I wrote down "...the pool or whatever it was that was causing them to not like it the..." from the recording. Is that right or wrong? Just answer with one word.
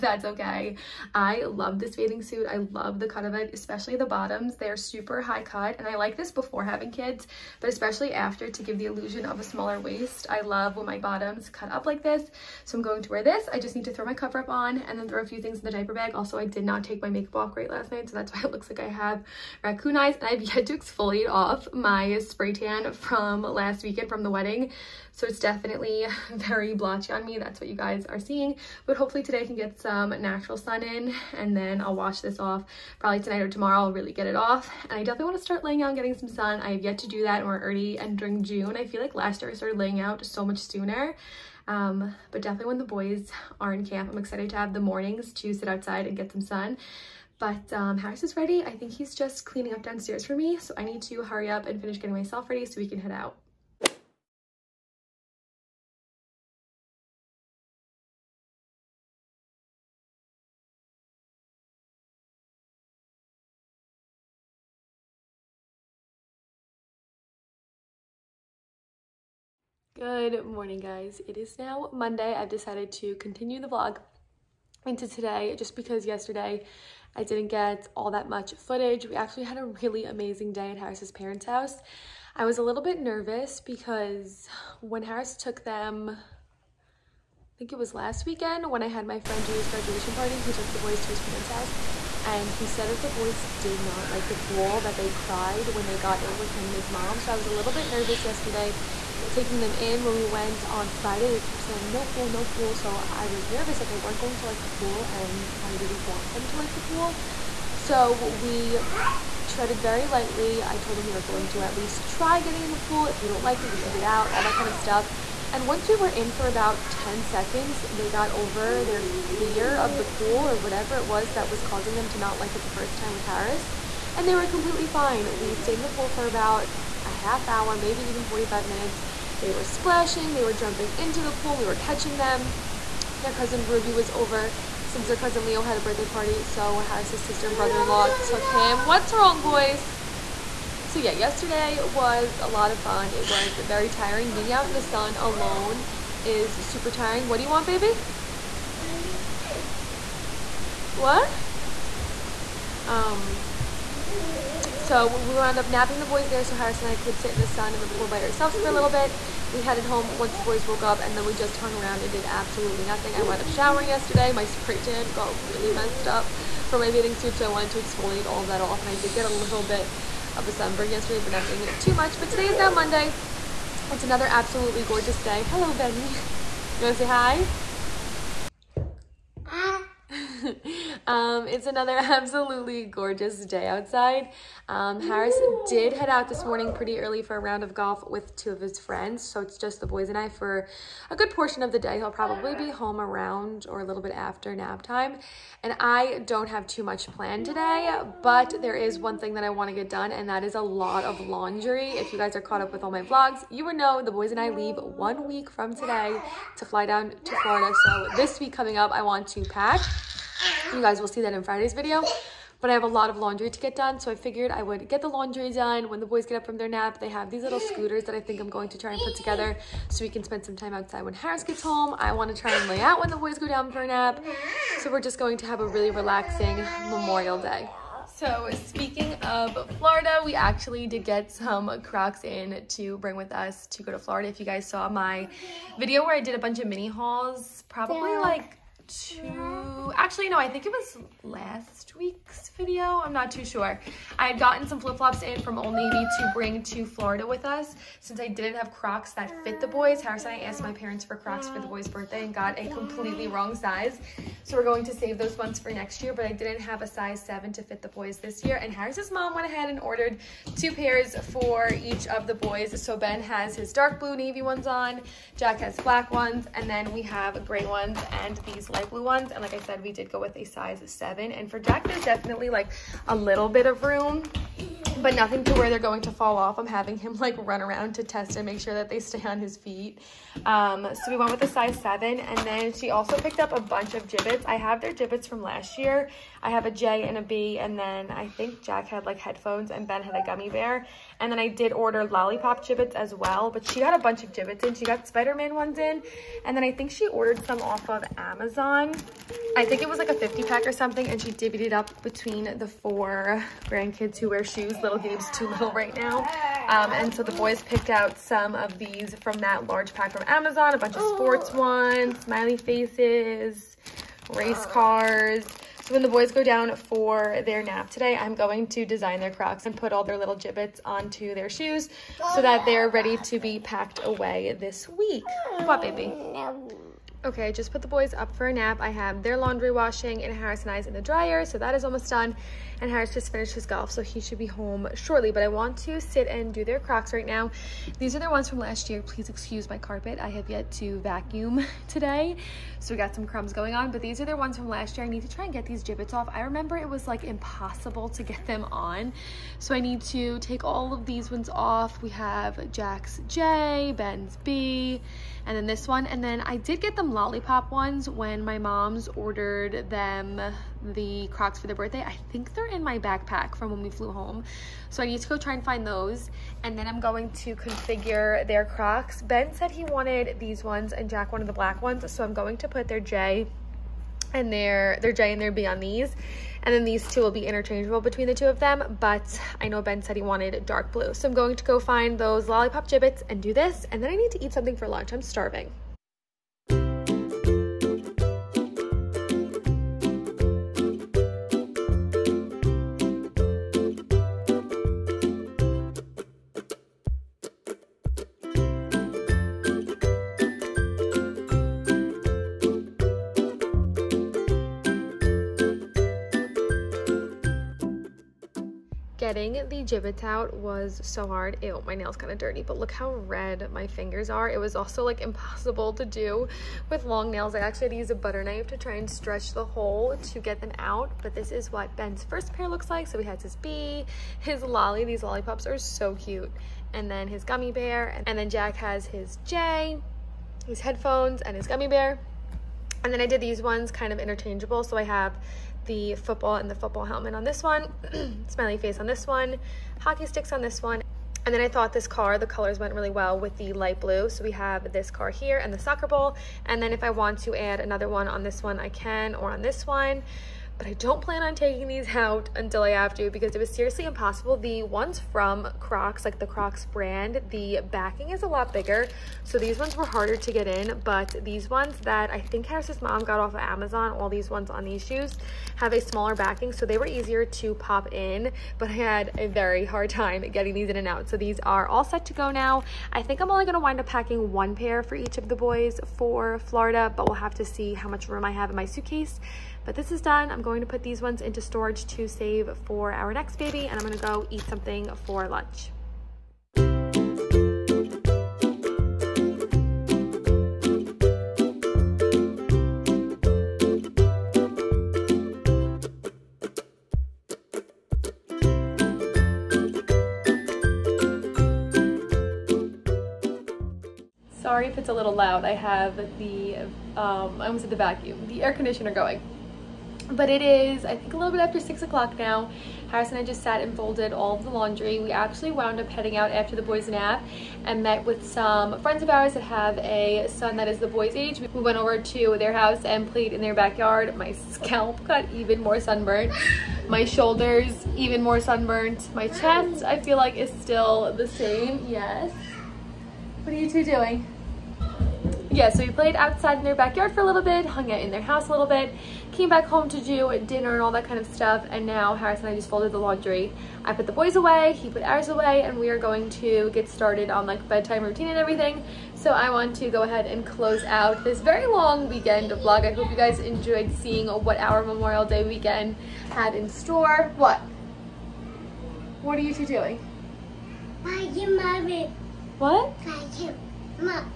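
right.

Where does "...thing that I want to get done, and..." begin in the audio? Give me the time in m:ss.
3:19.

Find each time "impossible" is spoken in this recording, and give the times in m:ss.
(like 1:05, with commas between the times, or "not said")
5:47, 6:55, 7:34.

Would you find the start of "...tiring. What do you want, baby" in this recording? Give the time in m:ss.
2:26.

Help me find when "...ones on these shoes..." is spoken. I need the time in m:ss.
7:44.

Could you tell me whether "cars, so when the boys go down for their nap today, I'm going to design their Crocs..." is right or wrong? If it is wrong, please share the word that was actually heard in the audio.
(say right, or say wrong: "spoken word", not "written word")
right.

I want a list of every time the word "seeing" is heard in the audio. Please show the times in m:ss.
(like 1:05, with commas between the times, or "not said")
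0:28, 9:14.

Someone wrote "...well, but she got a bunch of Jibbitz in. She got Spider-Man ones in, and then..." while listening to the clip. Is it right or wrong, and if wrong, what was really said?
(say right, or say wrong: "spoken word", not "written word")
right.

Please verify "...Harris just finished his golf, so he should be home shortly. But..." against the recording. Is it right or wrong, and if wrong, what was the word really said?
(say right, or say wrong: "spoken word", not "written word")
right.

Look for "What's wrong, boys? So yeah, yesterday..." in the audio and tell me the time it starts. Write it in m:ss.
2:18.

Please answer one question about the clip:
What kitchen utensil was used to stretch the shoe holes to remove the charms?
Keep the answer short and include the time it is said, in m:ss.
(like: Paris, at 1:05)
butter knife, at 6:58.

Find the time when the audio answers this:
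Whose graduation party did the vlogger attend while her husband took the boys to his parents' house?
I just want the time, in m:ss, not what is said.
1:29.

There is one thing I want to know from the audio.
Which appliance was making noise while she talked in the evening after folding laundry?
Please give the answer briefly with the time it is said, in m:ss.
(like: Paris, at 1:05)
air conditioner, at 8:28.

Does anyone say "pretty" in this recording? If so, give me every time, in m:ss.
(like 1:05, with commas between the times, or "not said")
3:06.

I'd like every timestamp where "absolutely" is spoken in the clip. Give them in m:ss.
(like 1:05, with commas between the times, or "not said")
2:42, 2:54, 3:01.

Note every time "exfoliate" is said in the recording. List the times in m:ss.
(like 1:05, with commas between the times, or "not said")
0:20, 2:47.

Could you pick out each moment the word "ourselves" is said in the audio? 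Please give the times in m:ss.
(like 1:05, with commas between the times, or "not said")
2:38.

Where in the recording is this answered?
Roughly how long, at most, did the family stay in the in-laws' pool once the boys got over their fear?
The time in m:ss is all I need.
2:08.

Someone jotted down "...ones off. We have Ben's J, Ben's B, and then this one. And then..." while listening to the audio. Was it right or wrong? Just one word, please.
wrong.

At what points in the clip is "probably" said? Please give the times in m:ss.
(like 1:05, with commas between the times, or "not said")
0:32, 3:12, 3:57.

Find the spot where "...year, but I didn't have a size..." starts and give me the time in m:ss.
4:16.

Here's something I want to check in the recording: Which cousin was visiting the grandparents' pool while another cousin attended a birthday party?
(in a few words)
Ruby.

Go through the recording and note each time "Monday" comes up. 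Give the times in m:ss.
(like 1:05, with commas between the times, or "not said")
1:11, 2:52.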